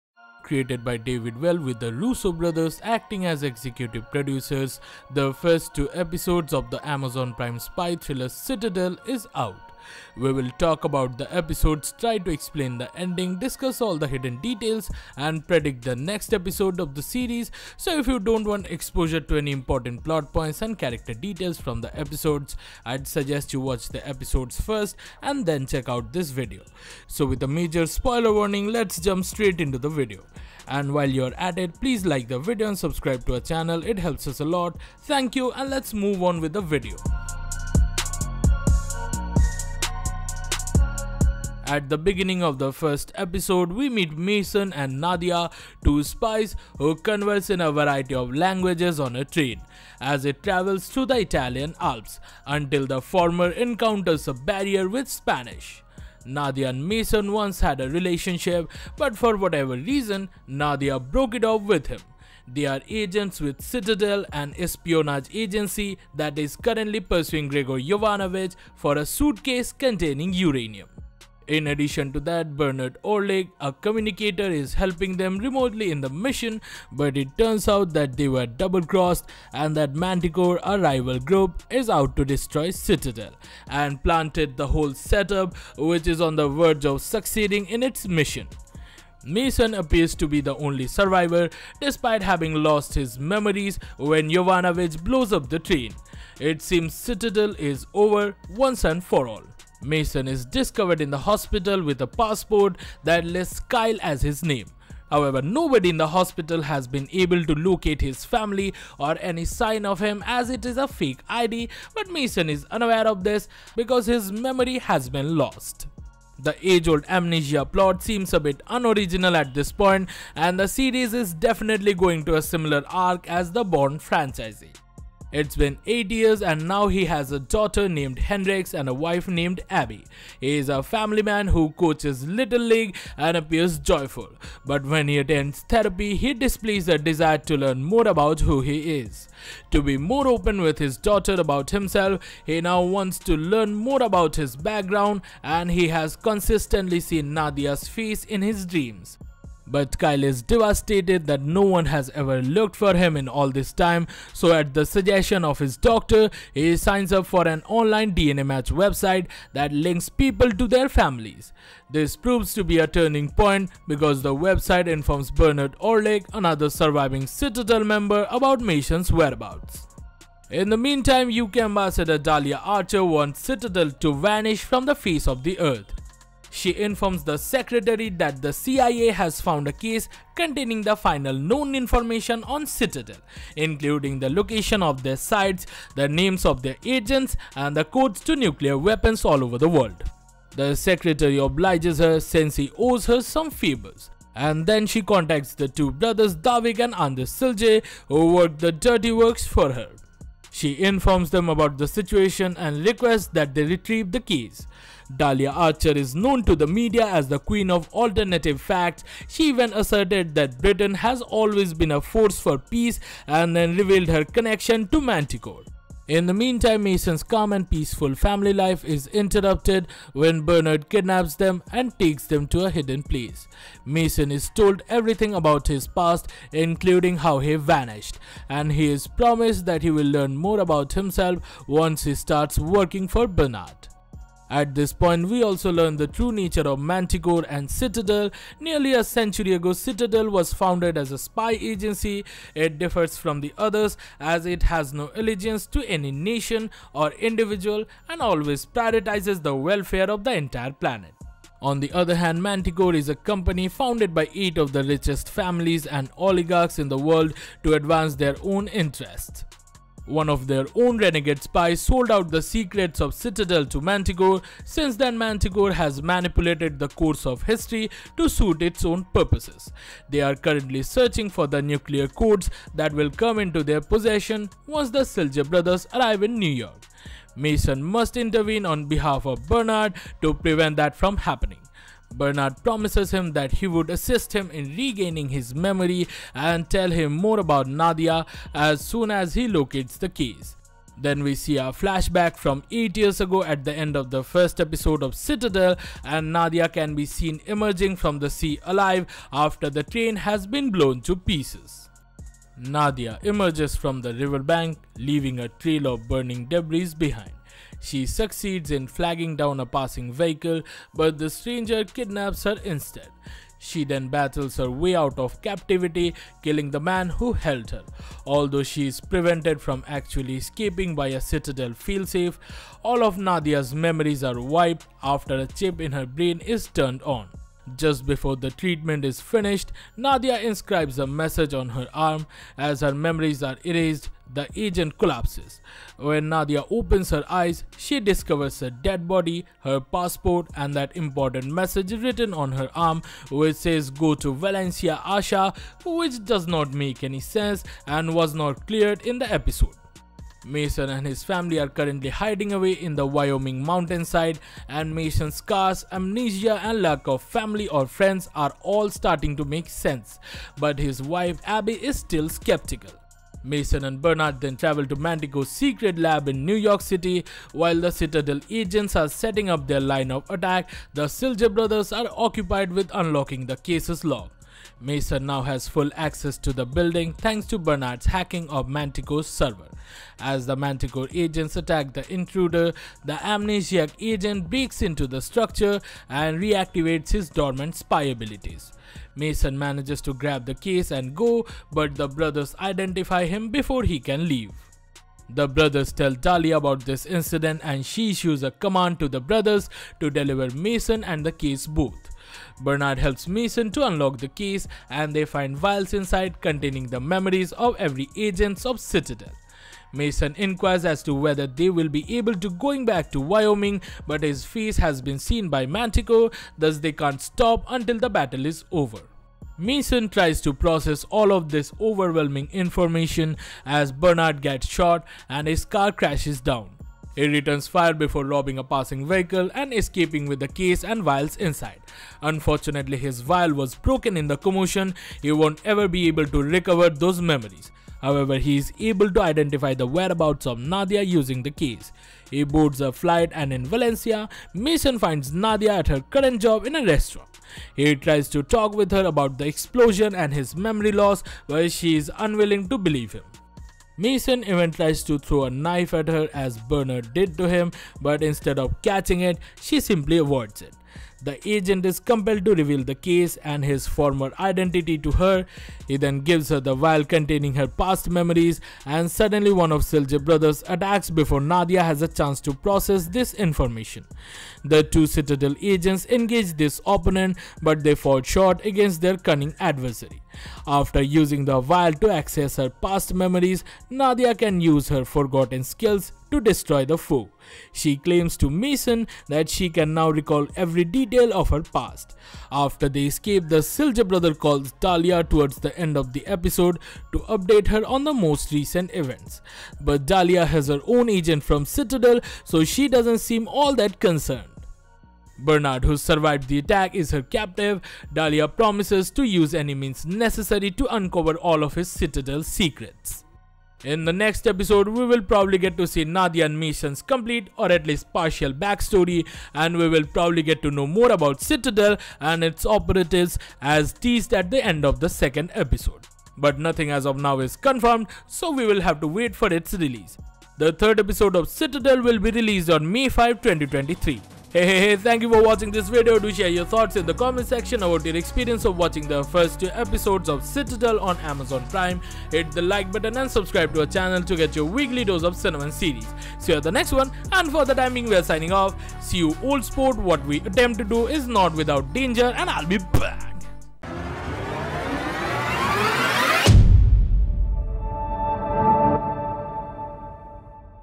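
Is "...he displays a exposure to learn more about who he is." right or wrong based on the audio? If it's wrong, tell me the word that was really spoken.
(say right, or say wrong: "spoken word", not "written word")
wrong: "desire", not "exposure".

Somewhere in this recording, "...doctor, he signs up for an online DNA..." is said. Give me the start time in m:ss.
2:35.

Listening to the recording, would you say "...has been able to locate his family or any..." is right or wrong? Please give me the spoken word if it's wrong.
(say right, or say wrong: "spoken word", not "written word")
right.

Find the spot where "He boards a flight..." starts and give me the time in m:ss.
7:22.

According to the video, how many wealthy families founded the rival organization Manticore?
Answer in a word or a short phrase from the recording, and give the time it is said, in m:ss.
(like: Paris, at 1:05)
8, at 4:14.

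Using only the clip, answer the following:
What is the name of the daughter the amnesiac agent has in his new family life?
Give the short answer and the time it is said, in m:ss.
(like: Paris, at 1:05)
Hendrix, at 2:08.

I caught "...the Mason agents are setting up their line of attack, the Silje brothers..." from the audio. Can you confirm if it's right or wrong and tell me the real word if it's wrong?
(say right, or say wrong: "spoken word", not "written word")
wrong: "Citadel", not "Mason".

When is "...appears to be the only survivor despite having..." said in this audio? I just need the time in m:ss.
1:29.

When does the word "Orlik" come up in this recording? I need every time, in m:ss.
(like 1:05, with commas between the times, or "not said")
1:13, 2:45.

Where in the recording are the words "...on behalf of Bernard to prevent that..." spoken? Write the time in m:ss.
4:38.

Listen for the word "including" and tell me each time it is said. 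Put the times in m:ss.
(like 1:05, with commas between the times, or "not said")
3:03, 3:46.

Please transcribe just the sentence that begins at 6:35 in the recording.
The brothers tell Dahlia about this incident and she issues a command to the brothers to deliver Mason and the case both.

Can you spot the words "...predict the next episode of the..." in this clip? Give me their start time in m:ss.
0:15.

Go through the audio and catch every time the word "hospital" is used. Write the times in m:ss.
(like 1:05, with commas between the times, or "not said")
1:41, 1:46.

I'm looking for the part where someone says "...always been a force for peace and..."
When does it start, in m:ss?
3:31.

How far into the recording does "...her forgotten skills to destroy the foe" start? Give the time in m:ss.
8:04.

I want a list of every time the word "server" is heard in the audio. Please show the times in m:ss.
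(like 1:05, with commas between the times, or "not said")
6:19.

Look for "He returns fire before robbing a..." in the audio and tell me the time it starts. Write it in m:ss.
7:07.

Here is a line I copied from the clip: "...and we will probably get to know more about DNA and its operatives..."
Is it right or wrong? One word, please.
wrong.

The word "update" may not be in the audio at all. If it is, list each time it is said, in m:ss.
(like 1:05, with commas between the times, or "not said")
8:17.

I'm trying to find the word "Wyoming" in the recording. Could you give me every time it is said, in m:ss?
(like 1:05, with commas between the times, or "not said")
5:53, 6:53.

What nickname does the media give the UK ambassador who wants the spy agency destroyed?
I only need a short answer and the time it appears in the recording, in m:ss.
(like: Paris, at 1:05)
queen of alternative facts, at 3:27.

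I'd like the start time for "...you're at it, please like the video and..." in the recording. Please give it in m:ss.
0:31.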